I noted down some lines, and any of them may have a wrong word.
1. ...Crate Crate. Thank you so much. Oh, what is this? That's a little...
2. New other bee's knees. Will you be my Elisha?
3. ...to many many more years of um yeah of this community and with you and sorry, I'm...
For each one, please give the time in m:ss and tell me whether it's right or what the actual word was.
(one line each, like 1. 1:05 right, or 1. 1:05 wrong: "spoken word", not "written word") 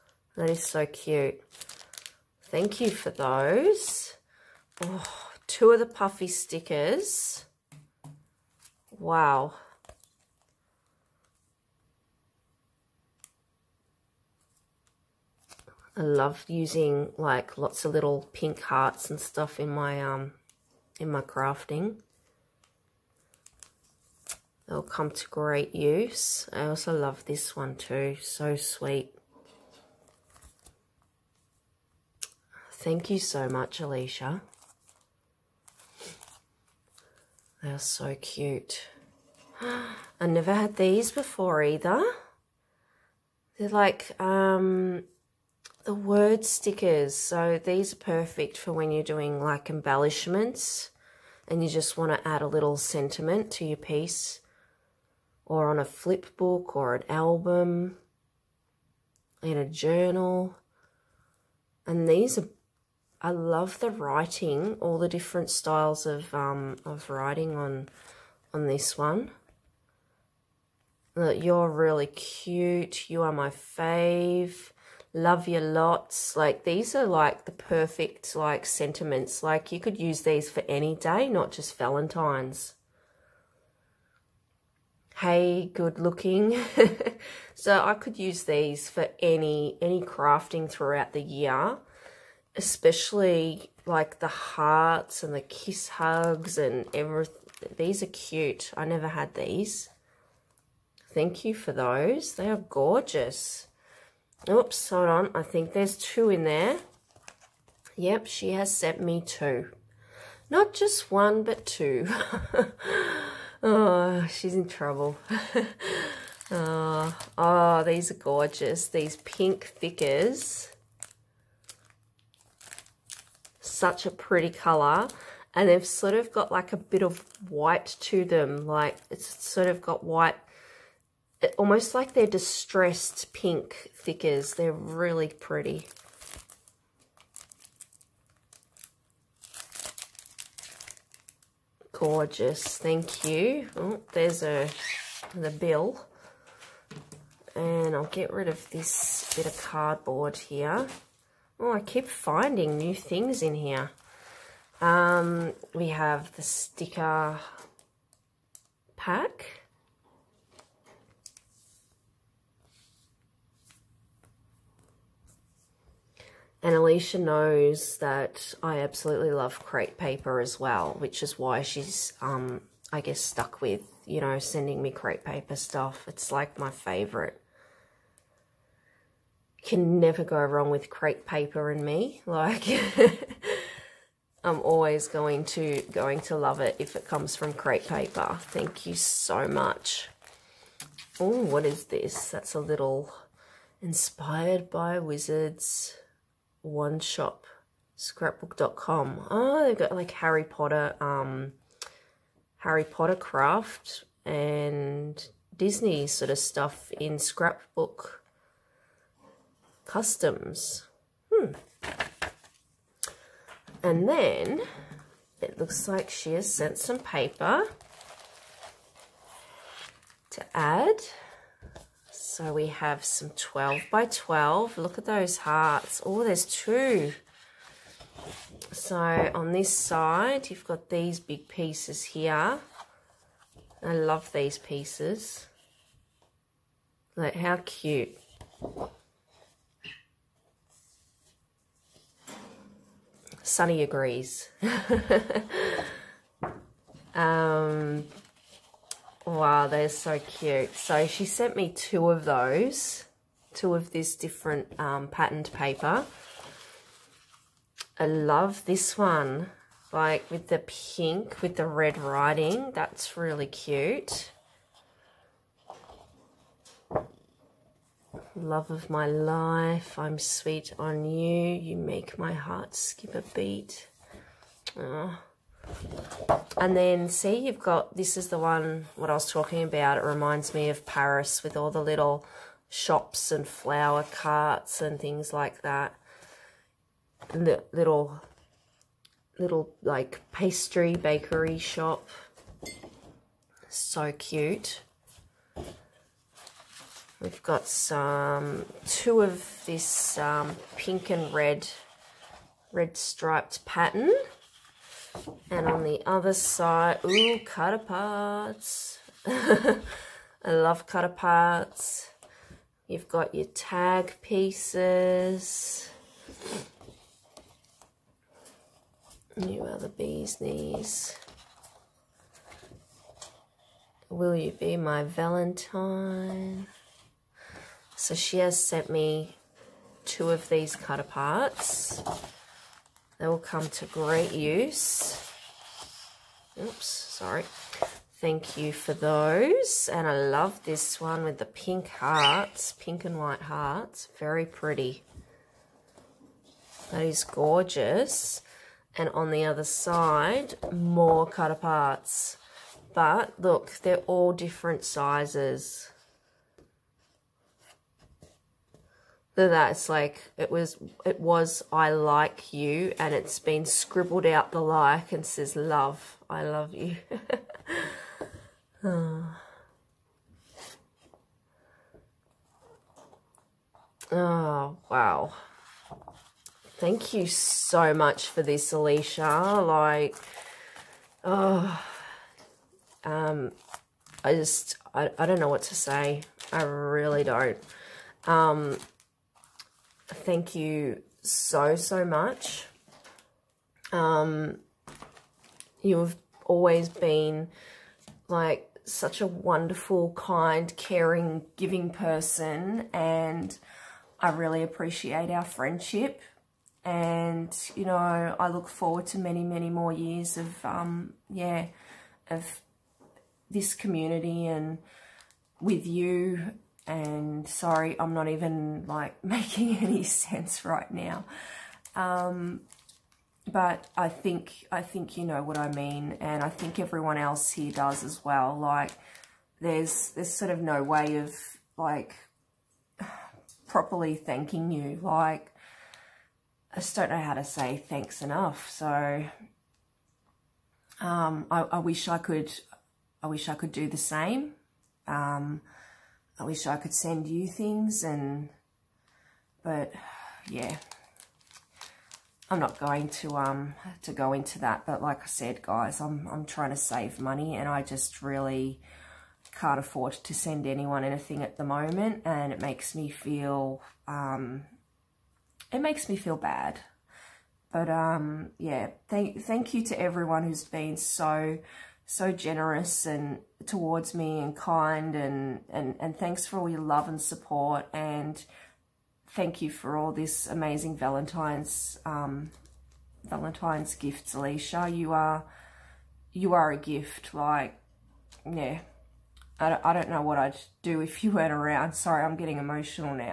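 1. 3:07 wrong: "Paper", not "Crate"
2. 5:19 wrong: "Valentine", not "Elisha"
3. 6:49 right.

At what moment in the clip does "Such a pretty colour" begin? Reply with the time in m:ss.
2:03.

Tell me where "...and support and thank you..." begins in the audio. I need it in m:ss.
7:57.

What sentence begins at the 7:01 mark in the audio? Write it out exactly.
Um, but I think, I think you know what I mean.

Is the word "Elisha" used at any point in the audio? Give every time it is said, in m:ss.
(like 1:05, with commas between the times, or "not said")
0:33, 2:46, 6:18, 8:04.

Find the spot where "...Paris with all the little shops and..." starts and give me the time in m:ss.
4:40.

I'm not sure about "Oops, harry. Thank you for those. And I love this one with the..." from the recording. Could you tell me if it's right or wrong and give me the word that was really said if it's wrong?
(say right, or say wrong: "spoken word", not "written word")
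wrong: "sorry", not "harry".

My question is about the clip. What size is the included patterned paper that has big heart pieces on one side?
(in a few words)
12 by 12.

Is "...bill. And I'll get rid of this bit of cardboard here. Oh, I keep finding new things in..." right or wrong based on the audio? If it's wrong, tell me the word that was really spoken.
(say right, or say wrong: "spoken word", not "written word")
right.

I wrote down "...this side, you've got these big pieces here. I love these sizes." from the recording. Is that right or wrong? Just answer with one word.
wrong.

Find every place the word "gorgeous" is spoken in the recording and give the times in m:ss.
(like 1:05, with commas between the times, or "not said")
1:42, 1:58, 2:21, 5:47.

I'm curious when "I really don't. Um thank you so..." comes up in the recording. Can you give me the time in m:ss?
6:26.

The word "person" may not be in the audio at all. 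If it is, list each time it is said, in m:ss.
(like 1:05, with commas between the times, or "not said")
6:41.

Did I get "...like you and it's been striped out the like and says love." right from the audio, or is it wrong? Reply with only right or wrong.
wrong.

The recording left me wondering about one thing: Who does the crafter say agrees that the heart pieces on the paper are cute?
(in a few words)
Sunny.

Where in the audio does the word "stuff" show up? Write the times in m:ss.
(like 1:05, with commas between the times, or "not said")
0:19, 2:55, 3:26.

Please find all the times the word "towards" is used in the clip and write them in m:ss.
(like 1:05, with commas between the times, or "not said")
7:53.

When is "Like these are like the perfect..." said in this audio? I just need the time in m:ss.
1:16.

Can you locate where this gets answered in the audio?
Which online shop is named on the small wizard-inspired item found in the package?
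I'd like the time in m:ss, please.
3:17.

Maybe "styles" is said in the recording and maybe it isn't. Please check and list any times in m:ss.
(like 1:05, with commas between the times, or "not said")
1:05.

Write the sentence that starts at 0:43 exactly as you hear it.
They're like um, the word stickers.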